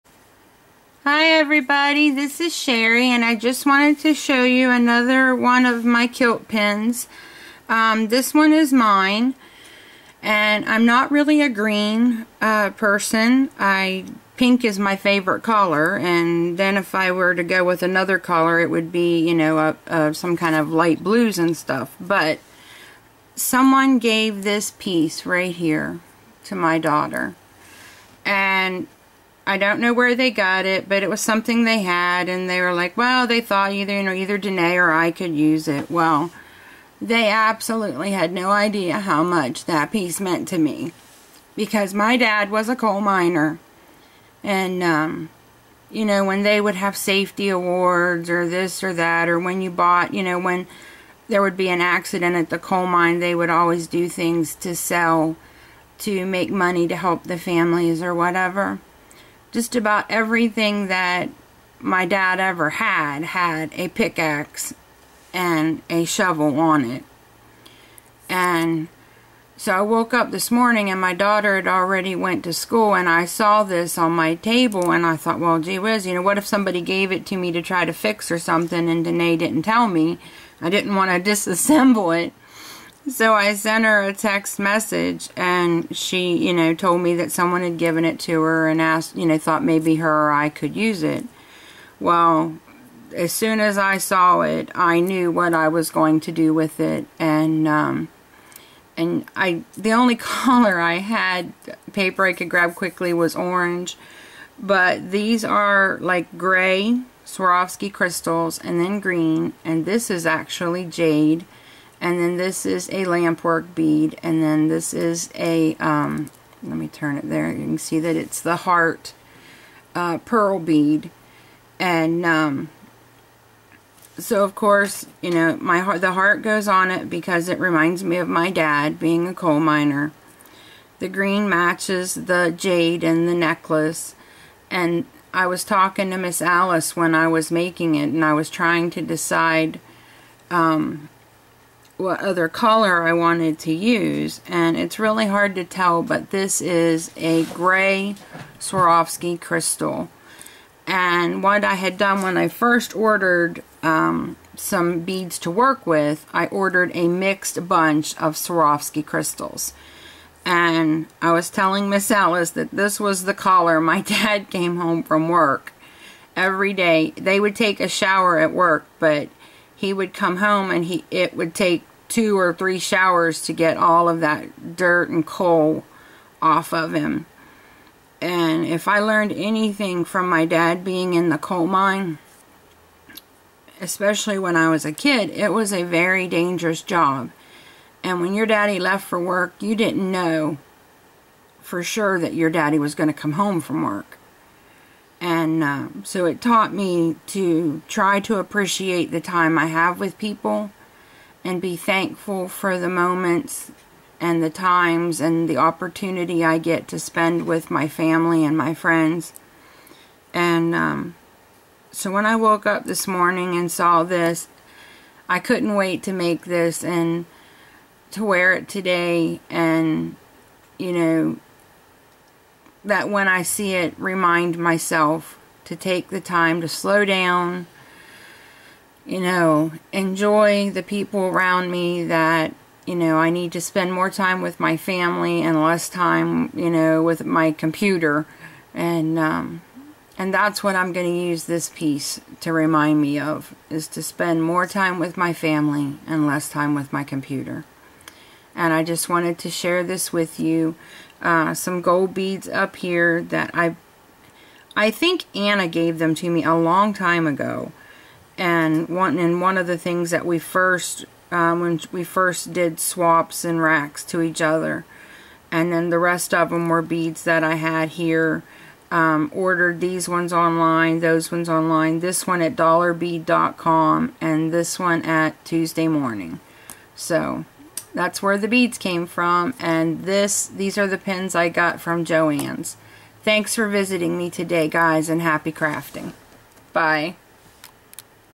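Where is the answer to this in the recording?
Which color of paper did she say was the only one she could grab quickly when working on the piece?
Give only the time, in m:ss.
1:43.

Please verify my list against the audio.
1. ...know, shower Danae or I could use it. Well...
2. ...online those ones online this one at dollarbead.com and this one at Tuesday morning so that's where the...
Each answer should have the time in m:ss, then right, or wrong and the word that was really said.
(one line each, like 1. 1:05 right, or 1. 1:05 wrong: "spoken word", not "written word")
1. 0:34 wrong: "either", not "shower"
2. 4:30 right.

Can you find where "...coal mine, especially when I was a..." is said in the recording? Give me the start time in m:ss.
3:01.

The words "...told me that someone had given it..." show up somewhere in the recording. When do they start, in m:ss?
1:26.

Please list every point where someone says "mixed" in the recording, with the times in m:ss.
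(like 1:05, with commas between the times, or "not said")
2:37.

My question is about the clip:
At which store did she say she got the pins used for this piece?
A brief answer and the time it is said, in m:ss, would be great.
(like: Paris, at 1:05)
Joann's, at 4:42.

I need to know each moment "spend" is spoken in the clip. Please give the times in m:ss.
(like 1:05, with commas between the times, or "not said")
3:26, 3:53, 4:04.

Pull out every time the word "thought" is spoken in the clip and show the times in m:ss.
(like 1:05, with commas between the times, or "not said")
0:33, 1:15, 1:29.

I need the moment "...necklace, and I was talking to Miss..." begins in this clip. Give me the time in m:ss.
2:13.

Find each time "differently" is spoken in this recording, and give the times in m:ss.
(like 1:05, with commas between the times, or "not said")
not said.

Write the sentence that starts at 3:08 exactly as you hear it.
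And when your daddy left for work, you didn't know for sure that your daddy was going to come home from work.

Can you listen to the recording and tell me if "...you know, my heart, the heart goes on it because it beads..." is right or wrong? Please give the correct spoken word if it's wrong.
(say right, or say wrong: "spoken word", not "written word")
wrong: "reminds", not "beads".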